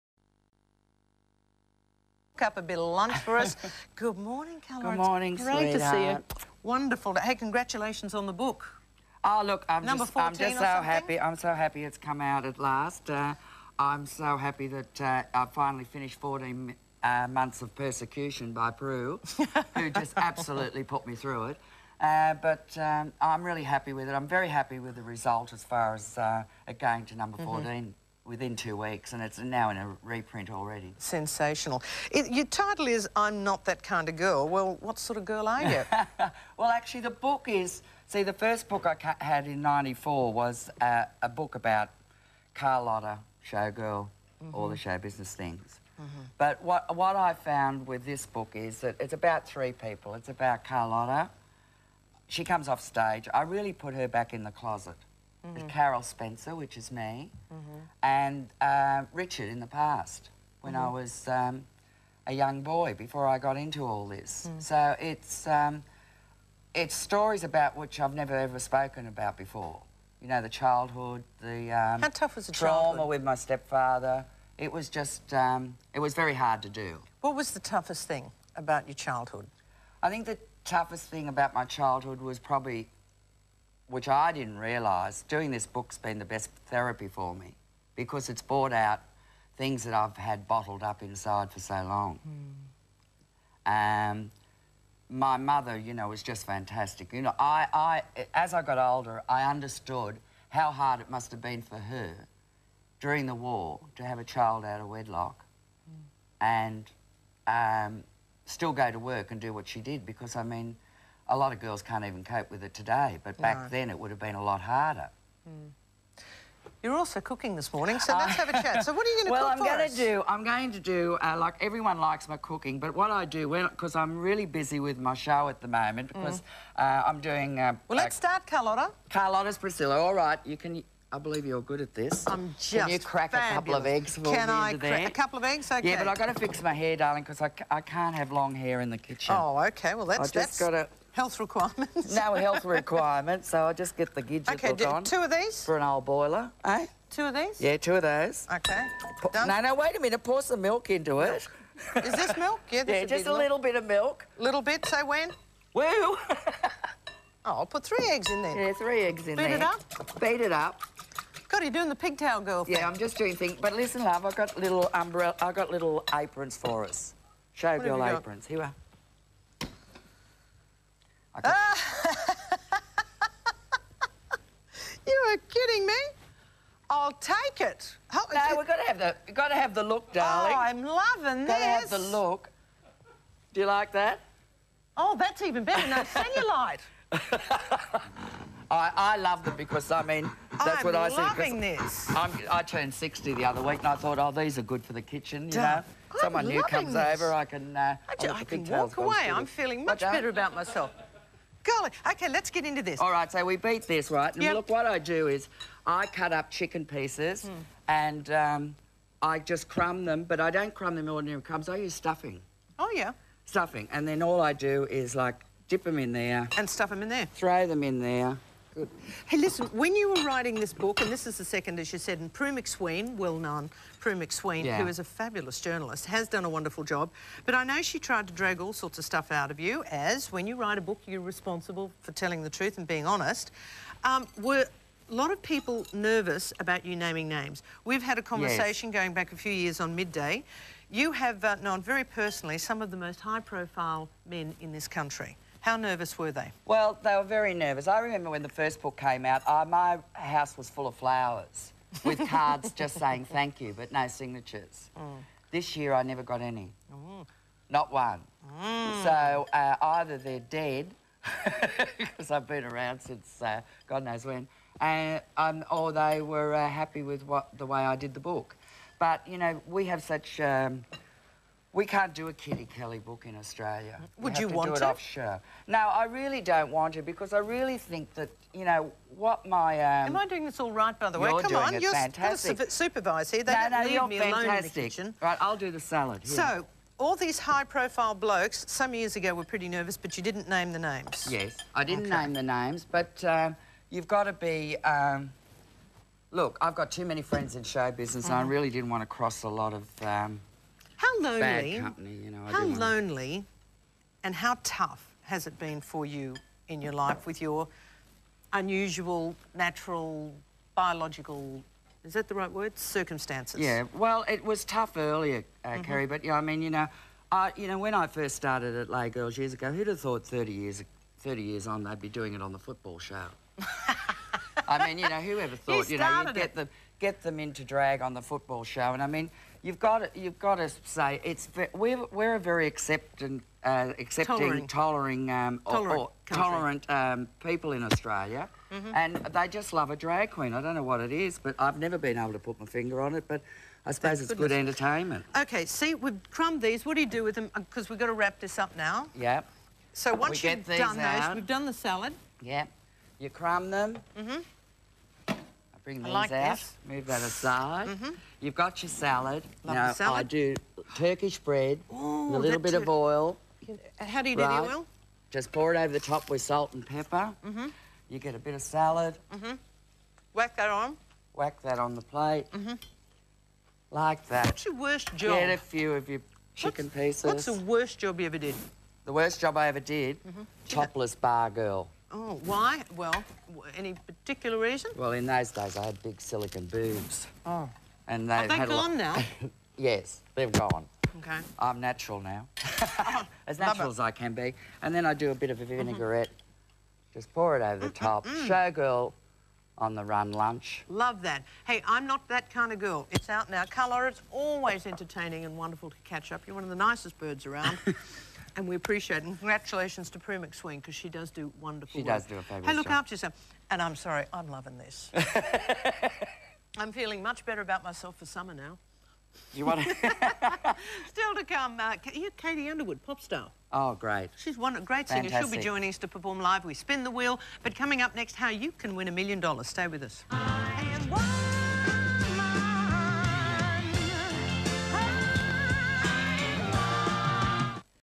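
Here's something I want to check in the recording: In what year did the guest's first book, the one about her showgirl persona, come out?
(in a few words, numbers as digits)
1994.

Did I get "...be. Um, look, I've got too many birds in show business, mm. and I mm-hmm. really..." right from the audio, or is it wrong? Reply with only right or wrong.
wrong.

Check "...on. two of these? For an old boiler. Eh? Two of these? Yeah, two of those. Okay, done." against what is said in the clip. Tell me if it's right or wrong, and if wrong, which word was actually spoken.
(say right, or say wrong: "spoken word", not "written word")
right.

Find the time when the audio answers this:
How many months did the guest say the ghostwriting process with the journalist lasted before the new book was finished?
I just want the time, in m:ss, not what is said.
0:16.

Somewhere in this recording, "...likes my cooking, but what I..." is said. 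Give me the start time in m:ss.
2:01.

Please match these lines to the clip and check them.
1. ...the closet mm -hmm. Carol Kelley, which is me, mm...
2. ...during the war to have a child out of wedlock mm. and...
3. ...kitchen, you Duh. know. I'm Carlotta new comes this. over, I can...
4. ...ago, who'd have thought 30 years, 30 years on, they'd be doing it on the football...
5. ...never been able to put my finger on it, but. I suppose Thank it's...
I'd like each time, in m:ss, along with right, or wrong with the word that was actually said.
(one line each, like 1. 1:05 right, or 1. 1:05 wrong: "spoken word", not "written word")
1. 0:54 wrong: "Spencer", not "Kelley"
2. 1:43 right
3. 3:15 wrong: "Someone", not "Carlotta"
4. 5:19 right
5. 5:41 right.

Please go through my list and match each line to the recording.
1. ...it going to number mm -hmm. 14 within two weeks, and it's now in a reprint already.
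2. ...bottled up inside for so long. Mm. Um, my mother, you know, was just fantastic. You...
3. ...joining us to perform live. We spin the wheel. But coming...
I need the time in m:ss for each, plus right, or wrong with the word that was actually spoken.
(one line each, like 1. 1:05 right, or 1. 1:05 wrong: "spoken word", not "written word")
1. 0:26 right
2. 1:30 right
3. 7:05 right.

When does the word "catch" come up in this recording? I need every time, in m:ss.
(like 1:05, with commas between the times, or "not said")
6:46.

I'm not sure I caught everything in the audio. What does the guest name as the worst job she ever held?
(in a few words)
Topless bar girl.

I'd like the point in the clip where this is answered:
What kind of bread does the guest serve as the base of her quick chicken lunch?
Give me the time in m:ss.
6:00.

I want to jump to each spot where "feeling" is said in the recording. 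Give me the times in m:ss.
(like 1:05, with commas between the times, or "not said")
3:19, 6:56.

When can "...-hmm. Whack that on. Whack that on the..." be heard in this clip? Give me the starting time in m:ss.
6:09.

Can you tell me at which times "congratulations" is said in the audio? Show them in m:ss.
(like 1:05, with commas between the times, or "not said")
0:07, 6:49.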